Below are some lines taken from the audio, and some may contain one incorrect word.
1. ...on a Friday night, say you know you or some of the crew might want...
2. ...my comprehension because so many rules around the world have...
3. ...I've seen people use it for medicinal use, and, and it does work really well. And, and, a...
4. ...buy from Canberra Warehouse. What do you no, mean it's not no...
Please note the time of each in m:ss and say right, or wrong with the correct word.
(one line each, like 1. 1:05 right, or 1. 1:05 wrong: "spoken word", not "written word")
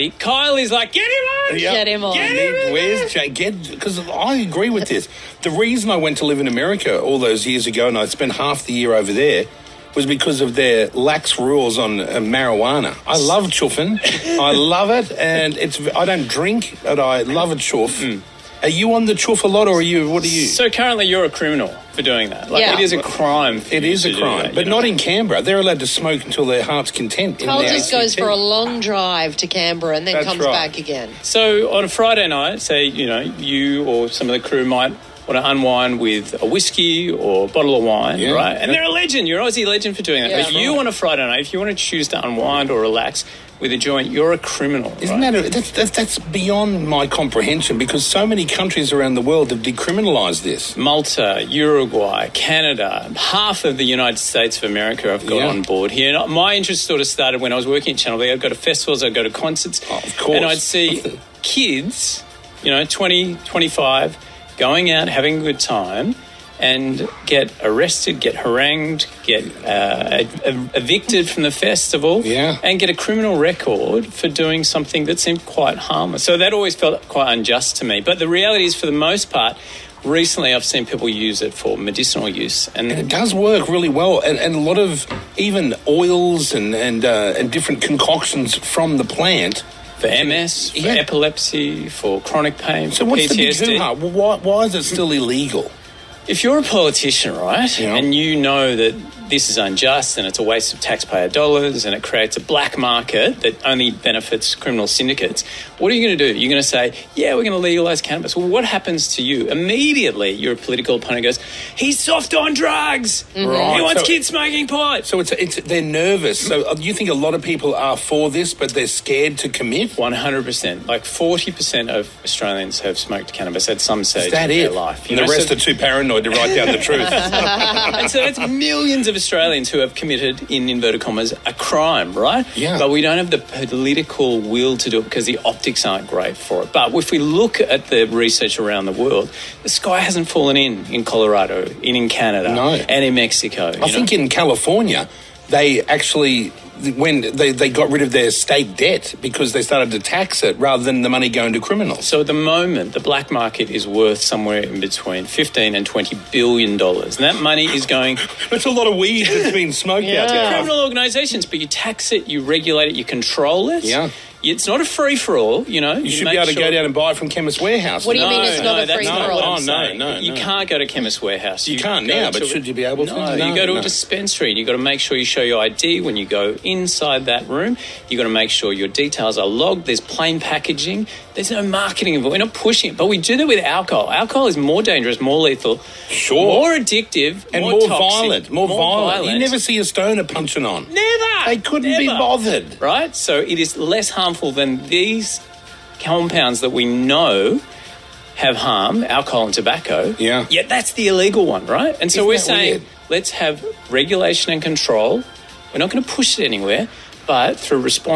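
1. 0:31 right
2. 0:46 wrong: "countries", not "rules"
3. 1:20 right
4. 2:46 wrong: "Chemist", not "Canberra".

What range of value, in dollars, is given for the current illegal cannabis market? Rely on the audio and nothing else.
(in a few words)
15 to 20 billion dollars.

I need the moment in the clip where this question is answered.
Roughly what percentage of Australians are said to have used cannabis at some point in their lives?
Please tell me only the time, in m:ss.
2:01.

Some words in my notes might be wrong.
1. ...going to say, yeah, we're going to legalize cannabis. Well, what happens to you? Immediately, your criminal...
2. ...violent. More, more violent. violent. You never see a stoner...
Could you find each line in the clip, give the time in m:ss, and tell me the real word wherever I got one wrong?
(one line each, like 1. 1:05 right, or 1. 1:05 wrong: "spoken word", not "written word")
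1. 1:46 wrong: "political", not "criminal"
2. 3:08 right.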